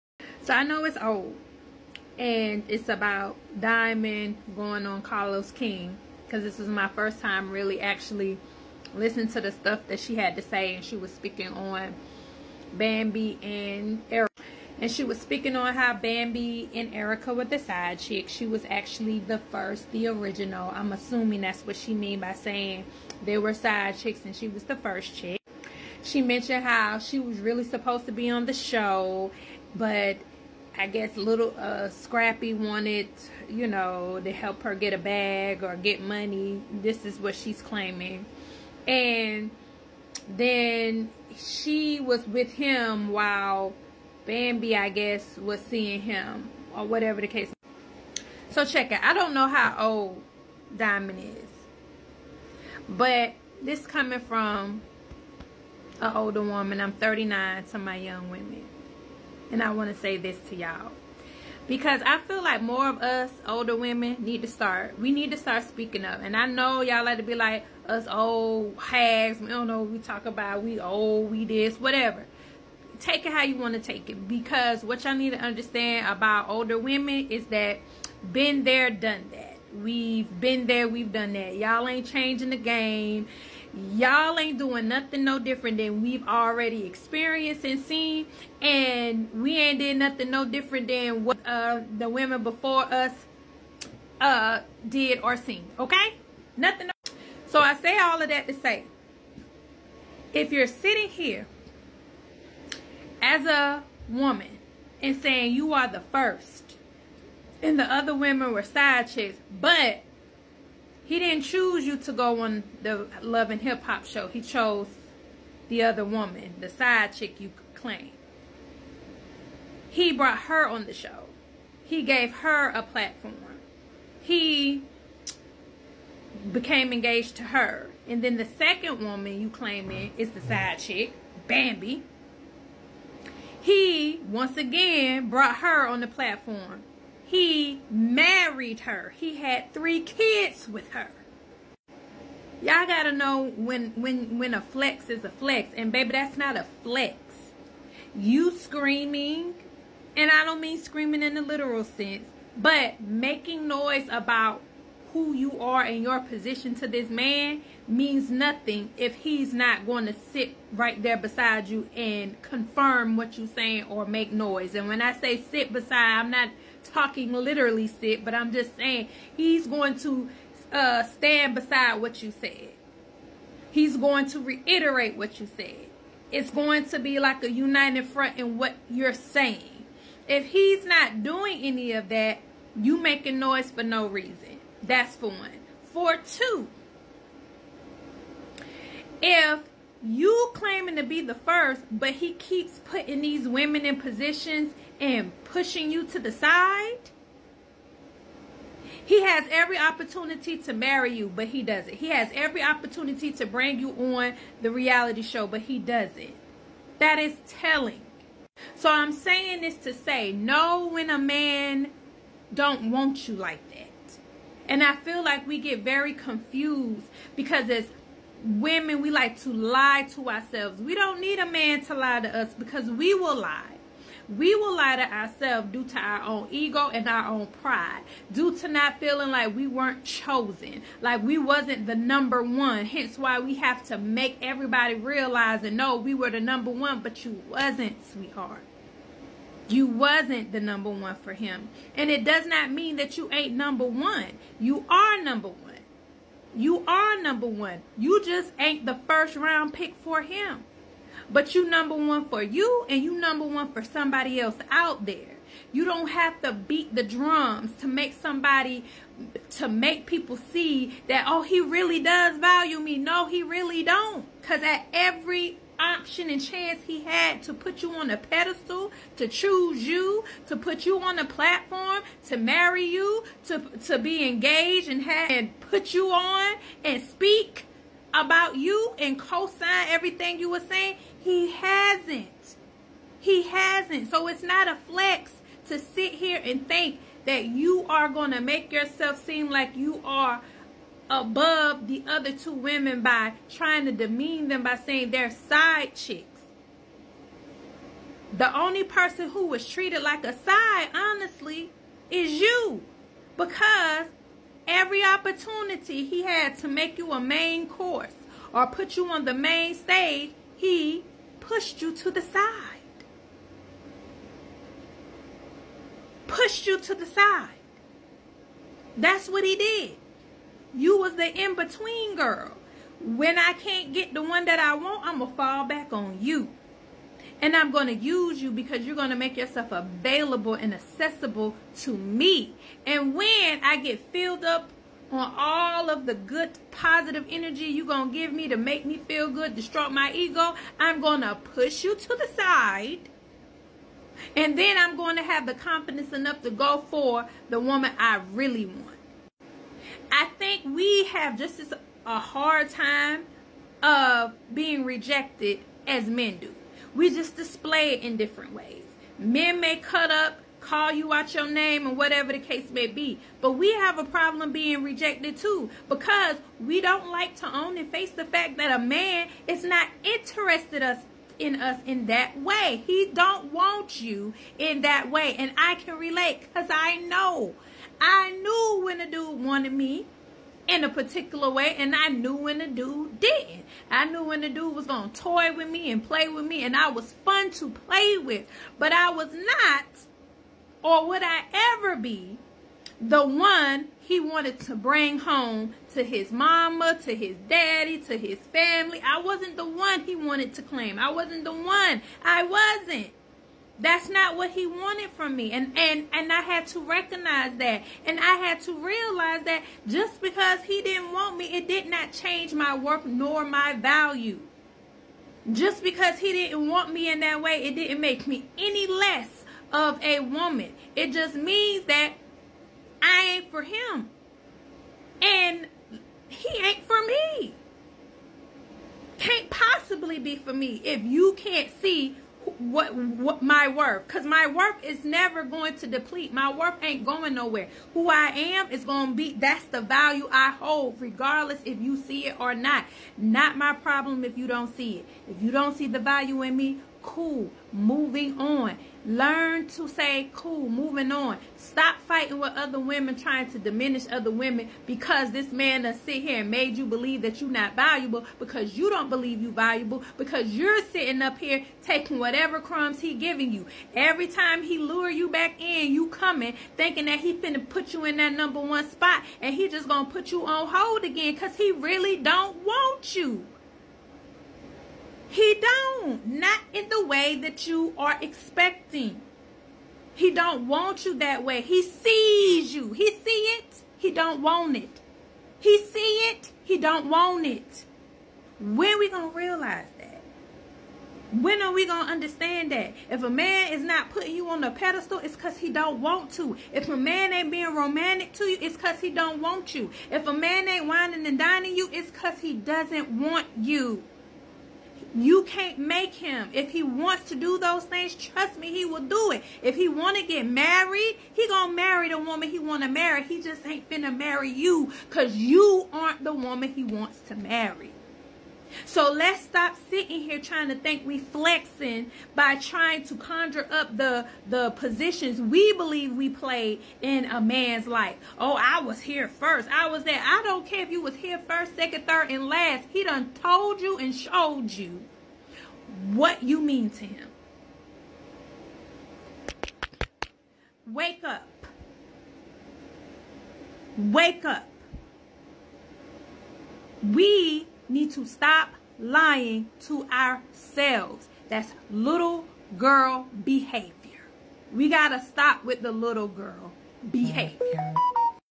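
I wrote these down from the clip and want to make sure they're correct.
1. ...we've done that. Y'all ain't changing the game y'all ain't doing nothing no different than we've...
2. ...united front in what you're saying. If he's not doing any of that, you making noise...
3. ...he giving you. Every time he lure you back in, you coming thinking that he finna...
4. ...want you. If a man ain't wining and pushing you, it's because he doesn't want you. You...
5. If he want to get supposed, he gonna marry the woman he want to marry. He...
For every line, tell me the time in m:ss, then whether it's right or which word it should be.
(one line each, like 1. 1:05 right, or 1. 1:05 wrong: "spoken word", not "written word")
1. 1:20 right
2. 2:57 right
3. 7:42 right
4. 8:19 wrong: "dining", not "pushing"
5. 8:29 wrong: "married", not "supposed".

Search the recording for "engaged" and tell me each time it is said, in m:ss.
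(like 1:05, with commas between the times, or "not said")
2:06, 4:34.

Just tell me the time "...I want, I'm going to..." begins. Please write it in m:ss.
5:24.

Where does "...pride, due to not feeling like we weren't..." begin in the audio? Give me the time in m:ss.
3:47.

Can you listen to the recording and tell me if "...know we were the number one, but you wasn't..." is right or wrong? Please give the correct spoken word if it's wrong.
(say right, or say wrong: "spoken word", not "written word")
right.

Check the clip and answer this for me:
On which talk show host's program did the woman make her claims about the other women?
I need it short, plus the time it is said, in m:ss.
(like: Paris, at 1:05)
Carlos King, at 0:05.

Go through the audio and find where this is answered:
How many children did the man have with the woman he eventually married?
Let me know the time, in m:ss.
2:19.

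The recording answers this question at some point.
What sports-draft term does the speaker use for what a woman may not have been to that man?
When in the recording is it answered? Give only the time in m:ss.
4:09.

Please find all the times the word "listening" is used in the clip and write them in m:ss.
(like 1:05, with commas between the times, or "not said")
0:08.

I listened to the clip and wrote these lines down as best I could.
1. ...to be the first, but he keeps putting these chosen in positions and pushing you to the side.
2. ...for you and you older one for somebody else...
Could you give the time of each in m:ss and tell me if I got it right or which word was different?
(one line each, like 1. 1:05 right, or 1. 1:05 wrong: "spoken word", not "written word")
1. 3:10 wrong: "women", not "chosen"
2. 4:12 wrong: "number", not "older".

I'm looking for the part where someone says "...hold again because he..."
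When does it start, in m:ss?
7:50.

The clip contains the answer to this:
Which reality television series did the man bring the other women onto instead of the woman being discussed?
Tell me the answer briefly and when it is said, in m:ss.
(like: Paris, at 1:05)
Love and Hip Hop, at 1:53.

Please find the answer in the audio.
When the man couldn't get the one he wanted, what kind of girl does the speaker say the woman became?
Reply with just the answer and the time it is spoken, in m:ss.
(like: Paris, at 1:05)
in-between girl, at 5:21.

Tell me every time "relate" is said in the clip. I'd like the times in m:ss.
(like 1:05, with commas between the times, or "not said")
6:15.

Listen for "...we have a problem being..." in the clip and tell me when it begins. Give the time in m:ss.
6:03.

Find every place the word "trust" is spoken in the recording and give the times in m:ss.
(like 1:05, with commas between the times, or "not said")
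8:28.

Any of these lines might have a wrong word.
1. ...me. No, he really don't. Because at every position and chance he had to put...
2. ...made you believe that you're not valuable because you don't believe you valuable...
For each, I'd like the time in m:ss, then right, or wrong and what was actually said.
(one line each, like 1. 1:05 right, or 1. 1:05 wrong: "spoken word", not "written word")
1. 4:22 wrong: "option", not "position"
2. 7:36 right.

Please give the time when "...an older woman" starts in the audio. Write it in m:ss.
0:56.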